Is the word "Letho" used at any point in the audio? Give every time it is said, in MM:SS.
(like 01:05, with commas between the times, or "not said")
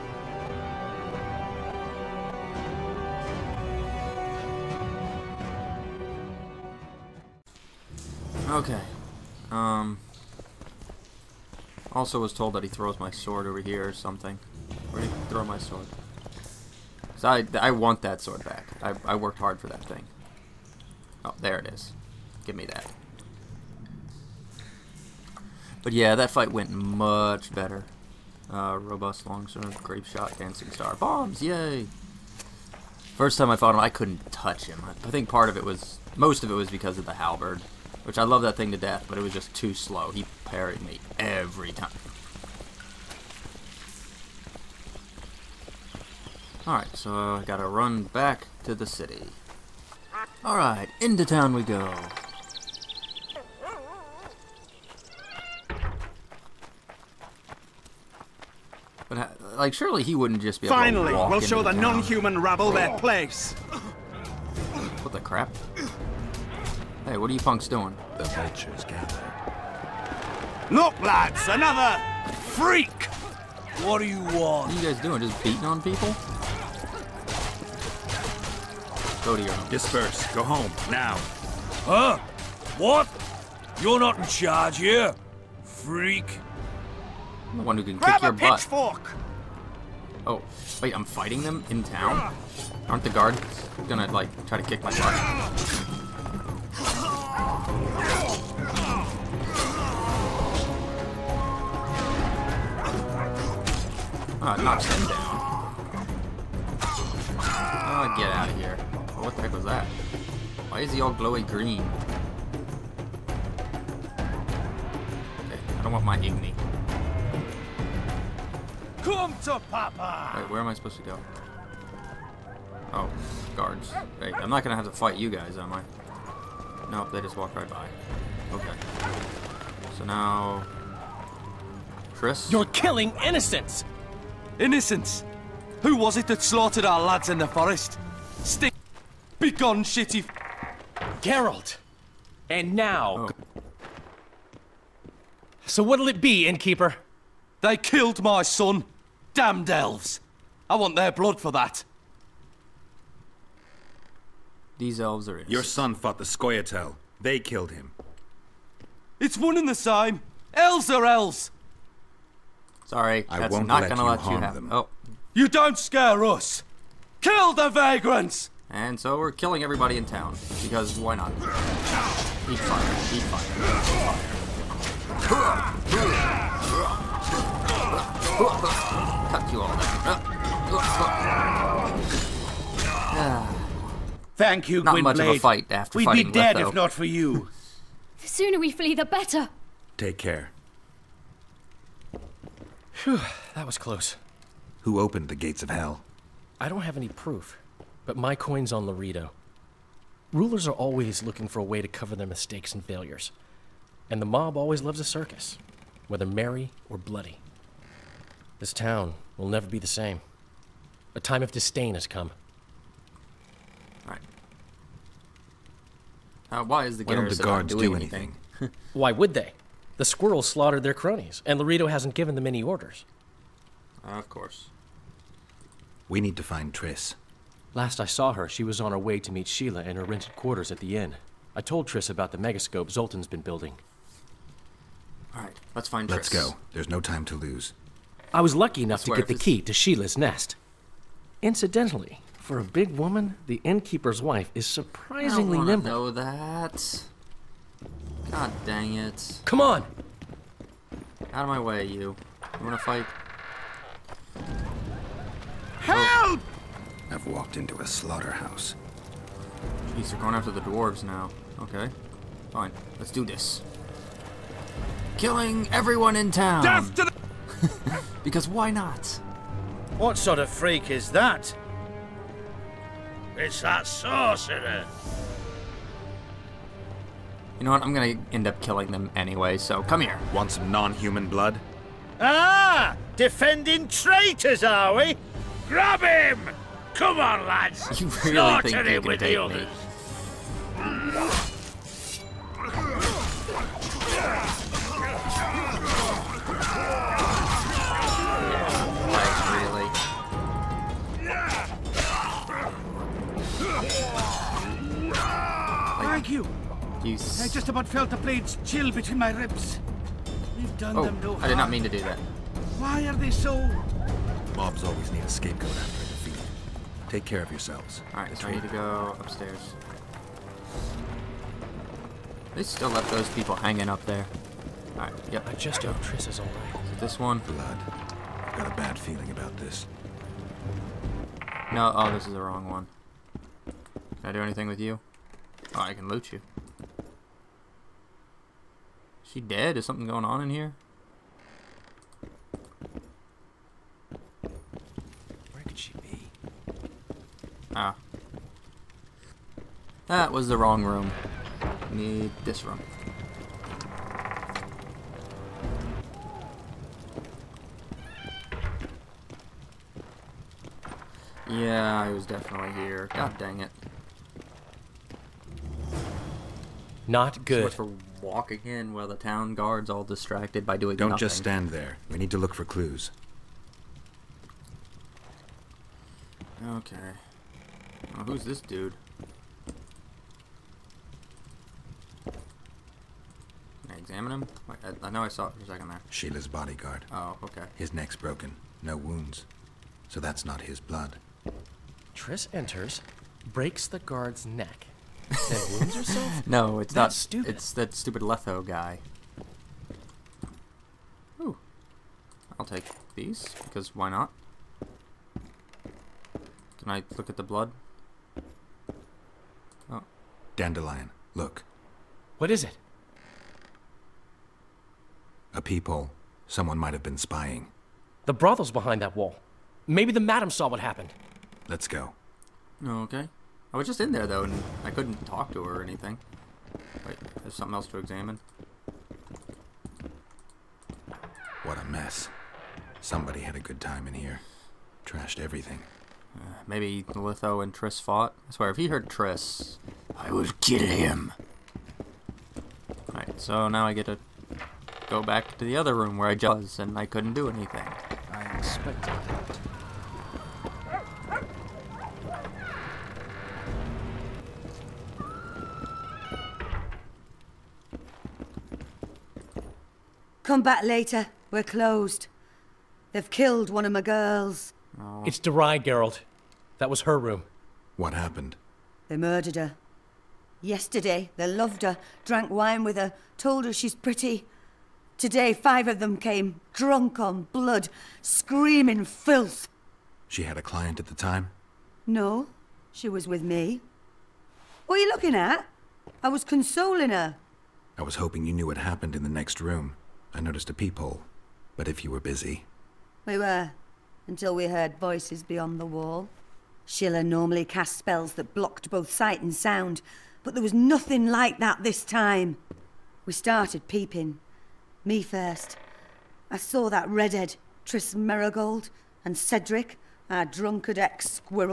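03:06, 06:38, 07:17.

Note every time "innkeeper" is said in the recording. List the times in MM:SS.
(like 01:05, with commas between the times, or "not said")
02:26, 04:03.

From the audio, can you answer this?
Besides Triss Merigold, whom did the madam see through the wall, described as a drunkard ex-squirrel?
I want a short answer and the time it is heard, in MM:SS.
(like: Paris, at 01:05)
Cedric, at 08:29.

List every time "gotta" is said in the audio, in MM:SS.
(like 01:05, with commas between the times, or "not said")
00:47.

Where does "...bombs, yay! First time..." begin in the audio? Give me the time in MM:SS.
00:30.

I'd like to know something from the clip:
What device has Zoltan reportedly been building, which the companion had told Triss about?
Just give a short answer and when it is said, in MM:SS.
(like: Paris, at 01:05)
megascope, at 03:52.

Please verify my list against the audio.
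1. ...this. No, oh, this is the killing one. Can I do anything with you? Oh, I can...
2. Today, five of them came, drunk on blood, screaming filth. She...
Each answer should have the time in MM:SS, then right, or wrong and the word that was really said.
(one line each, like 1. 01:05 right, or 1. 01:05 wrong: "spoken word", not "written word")
1. 05:29 wrong: "wrong", not "killing"
2. 07:55 right.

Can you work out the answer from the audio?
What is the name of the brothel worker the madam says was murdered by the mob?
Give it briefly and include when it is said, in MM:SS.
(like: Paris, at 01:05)
Deray, at 07:45.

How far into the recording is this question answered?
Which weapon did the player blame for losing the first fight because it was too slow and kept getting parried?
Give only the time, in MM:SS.
00:37.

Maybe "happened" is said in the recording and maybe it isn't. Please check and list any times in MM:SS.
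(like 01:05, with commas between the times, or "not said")
07:00, 07:48, 08:08.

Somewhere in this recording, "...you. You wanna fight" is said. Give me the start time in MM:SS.
04:11.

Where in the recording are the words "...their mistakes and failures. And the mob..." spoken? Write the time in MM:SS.
03:22.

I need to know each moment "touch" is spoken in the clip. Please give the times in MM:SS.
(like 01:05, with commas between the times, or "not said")
00:34.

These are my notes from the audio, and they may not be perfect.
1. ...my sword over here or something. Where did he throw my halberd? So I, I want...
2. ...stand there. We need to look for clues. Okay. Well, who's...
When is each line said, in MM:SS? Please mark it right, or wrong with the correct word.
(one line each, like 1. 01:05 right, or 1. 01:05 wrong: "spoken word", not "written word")
1. 00:12 wrong: "sword", not "halberd"
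2. 06:11 right.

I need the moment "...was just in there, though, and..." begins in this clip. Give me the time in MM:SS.
07:03.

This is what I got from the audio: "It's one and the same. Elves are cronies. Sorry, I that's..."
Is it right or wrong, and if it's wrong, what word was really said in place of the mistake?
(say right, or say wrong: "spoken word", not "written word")
wrong: "elves", not "cronies".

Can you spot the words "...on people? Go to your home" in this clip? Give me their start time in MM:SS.
01:15.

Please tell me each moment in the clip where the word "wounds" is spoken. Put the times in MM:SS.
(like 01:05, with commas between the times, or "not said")
06:28, 06:35.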